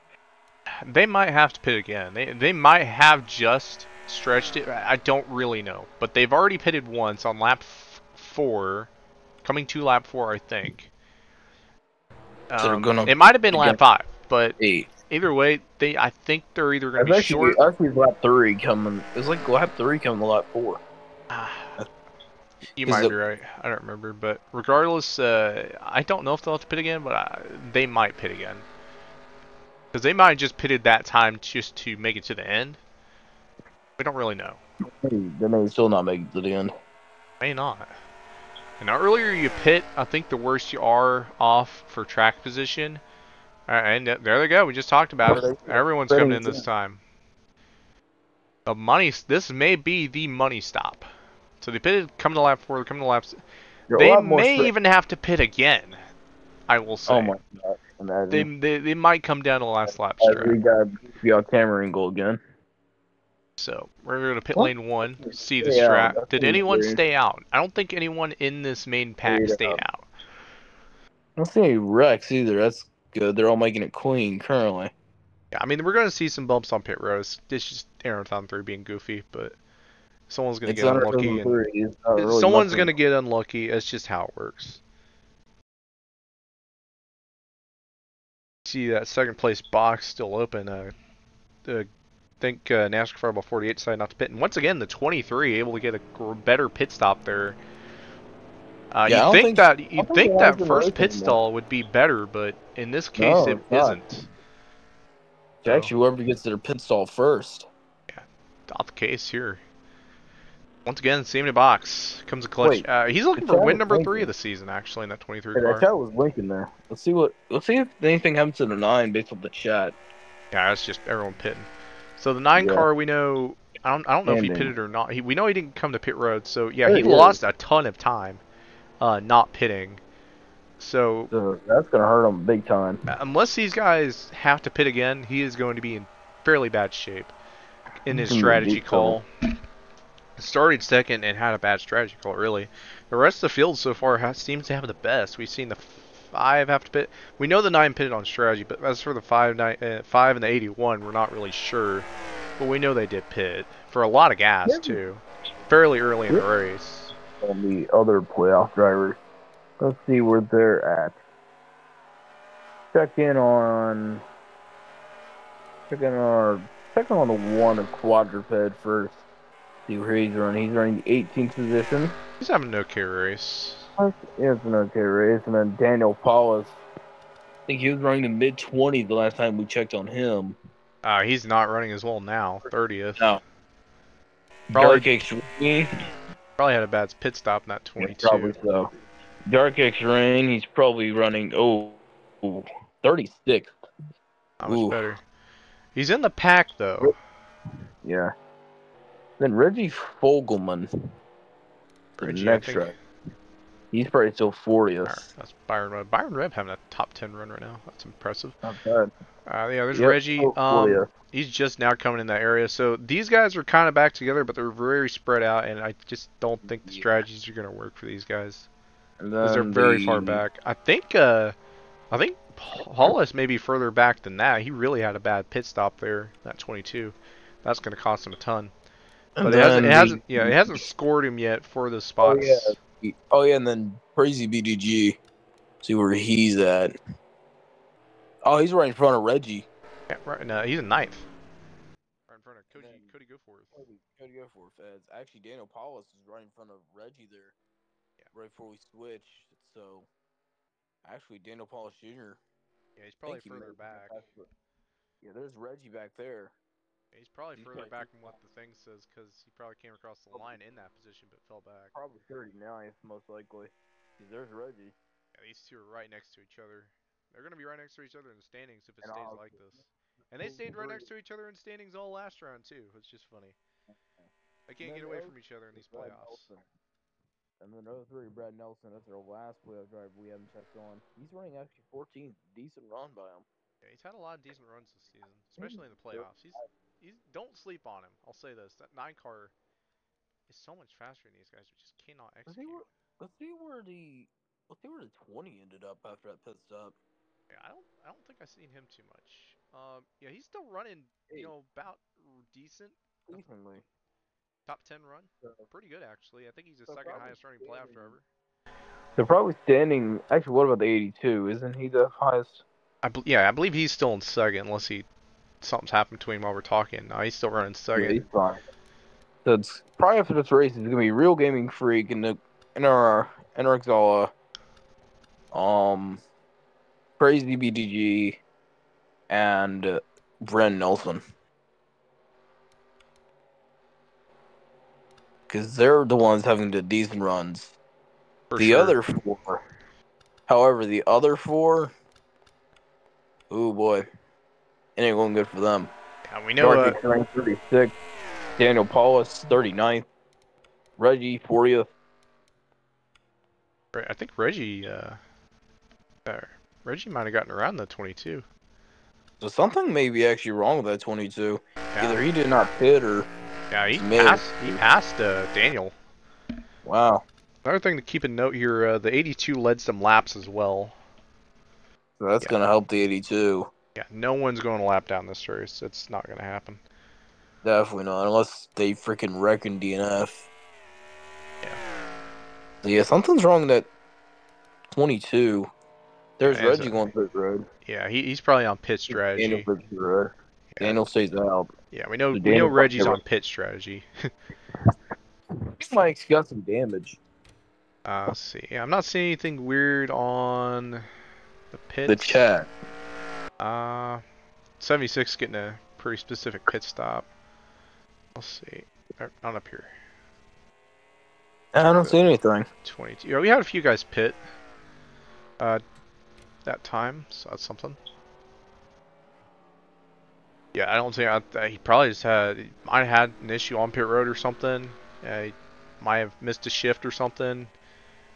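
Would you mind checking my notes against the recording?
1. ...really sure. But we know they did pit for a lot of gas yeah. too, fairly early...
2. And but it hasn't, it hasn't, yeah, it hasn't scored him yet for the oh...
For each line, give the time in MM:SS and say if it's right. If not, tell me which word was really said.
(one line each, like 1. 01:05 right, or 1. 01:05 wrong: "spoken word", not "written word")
1. 02:31 right
2. 03:49 right.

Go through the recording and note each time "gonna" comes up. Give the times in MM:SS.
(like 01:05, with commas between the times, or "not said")
02:11, 05:20.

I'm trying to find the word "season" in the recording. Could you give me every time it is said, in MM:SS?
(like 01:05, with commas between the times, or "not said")
01:54, 04:45.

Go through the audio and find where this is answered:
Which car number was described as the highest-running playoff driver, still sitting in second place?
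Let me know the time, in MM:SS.
05:10.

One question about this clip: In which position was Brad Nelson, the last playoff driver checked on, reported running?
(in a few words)
14th.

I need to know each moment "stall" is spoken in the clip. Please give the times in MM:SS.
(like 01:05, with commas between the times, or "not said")
01:41, 01:46.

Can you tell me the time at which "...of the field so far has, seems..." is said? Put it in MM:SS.
02:23.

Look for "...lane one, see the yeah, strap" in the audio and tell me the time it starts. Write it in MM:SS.
01:04.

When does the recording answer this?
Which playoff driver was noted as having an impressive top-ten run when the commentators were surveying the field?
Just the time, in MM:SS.
03:26.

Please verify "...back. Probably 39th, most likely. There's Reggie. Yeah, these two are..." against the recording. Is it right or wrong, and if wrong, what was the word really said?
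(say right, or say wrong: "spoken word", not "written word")
right.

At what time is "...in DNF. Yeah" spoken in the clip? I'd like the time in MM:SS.
06:19.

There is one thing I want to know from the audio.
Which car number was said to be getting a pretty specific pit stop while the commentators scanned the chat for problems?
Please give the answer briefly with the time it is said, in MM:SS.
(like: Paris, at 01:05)
76, at 06:44.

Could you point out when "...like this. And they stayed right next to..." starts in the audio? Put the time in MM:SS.
04:29.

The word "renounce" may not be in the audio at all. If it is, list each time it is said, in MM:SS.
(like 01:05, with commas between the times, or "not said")
not said.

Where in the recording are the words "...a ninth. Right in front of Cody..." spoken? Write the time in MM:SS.
04:00.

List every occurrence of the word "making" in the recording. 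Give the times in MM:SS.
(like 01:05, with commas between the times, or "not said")
01:13.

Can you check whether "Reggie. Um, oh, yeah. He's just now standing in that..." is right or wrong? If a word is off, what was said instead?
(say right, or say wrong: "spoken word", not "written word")
wrong: "coming", not "standing".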